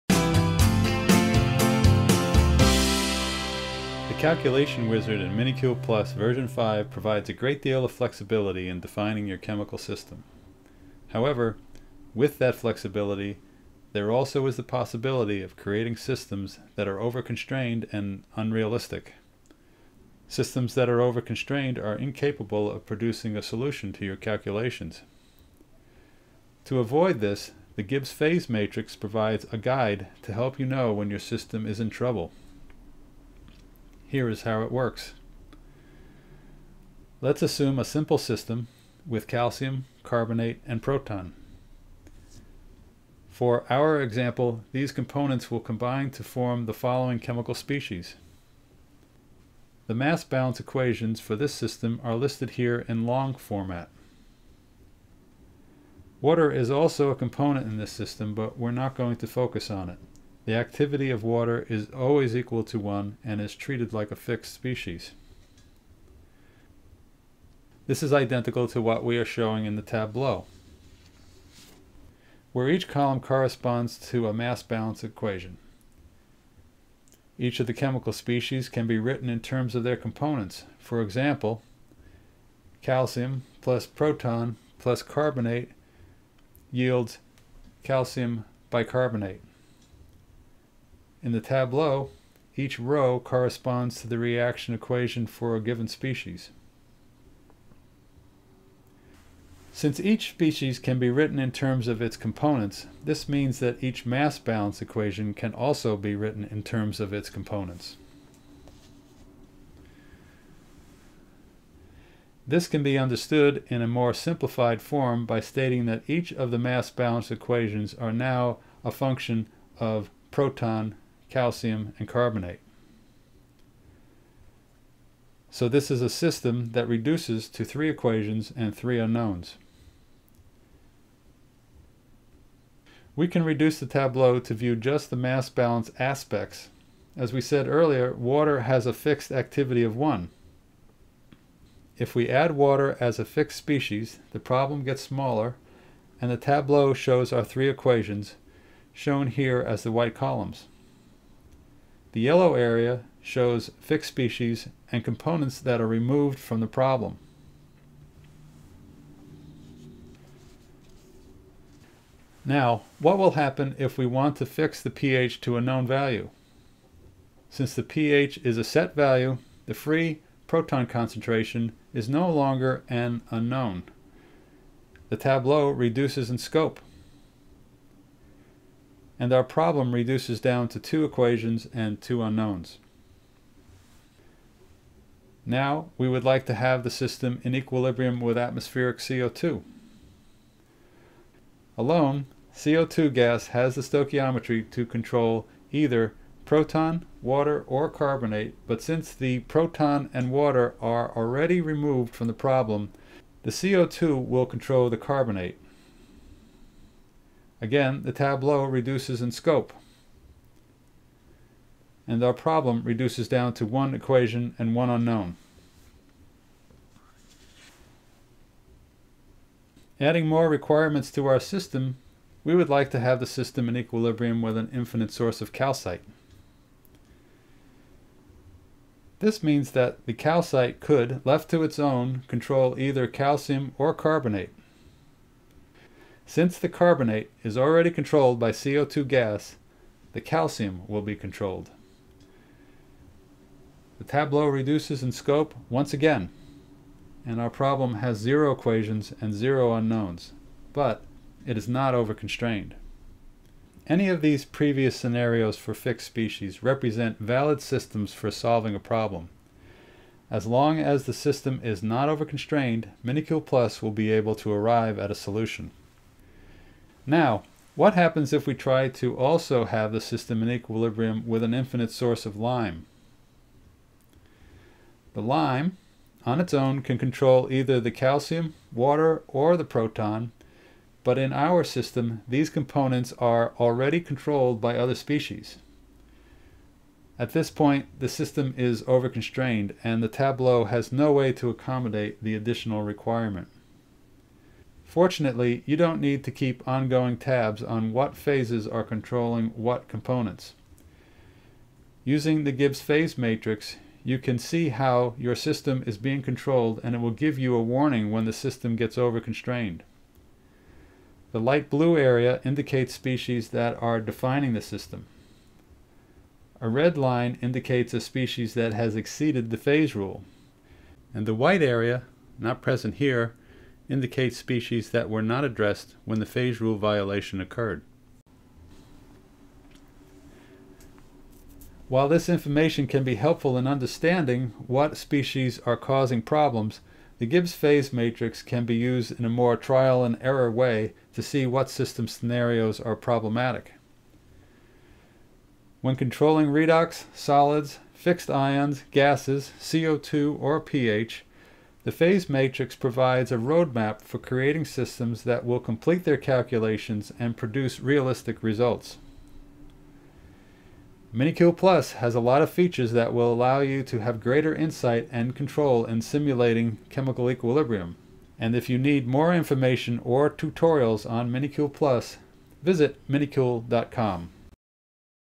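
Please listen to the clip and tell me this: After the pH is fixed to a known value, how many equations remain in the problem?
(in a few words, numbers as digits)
2.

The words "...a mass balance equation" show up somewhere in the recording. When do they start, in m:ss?
1:14.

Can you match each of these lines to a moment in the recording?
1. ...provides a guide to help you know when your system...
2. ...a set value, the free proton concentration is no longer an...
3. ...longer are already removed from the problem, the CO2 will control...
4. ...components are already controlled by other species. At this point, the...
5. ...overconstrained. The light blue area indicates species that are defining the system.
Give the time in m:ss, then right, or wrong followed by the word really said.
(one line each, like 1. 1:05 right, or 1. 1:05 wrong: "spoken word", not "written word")
1. 0:28 right
2. 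2:48 right
3. 3:20 wrong: "water", not "longer"
4. 4:42 right
5. 5:08 right.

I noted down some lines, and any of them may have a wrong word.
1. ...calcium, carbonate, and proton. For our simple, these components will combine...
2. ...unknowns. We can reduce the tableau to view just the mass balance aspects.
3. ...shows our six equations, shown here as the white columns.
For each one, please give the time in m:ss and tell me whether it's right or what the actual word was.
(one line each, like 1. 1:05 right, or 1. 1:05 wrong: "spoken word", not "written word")
1. 0:39 wrong: "example", not "simple"
2. 2:08 right
3. 2:26 wrong: "three", not "six".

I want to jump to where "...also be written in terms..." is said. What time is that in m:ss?
1:45.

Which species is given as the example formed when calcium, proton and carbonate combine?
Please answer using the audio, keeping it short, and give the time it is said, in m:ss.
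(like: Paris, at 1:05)
Calcium bicarbonate, at 1:27.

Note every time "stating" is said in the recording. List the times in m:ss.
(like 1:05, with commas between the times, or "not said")
1:55.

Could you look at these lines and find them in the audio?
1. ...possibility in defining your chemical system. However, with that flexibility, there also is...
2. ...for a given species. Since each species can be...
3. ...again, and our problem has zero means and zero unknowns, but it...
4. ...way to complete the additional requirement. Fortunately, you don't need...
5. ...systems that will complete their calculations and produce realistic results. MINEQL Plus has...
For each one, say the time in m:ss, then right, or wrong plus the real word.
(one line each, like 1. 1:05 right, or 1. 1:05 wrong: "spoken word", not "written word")
1. 0:07 wrong: "flexibility", not "possibility"
2. 1:35 right
3. 4:05 wrong: "equations", not "means"
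4. 4:51 wrong: "accommodate", not "complete"
5. 5:54 right.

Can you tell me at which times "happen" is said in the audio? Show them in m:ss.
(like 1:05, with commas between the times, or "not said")
2:43, 4:27.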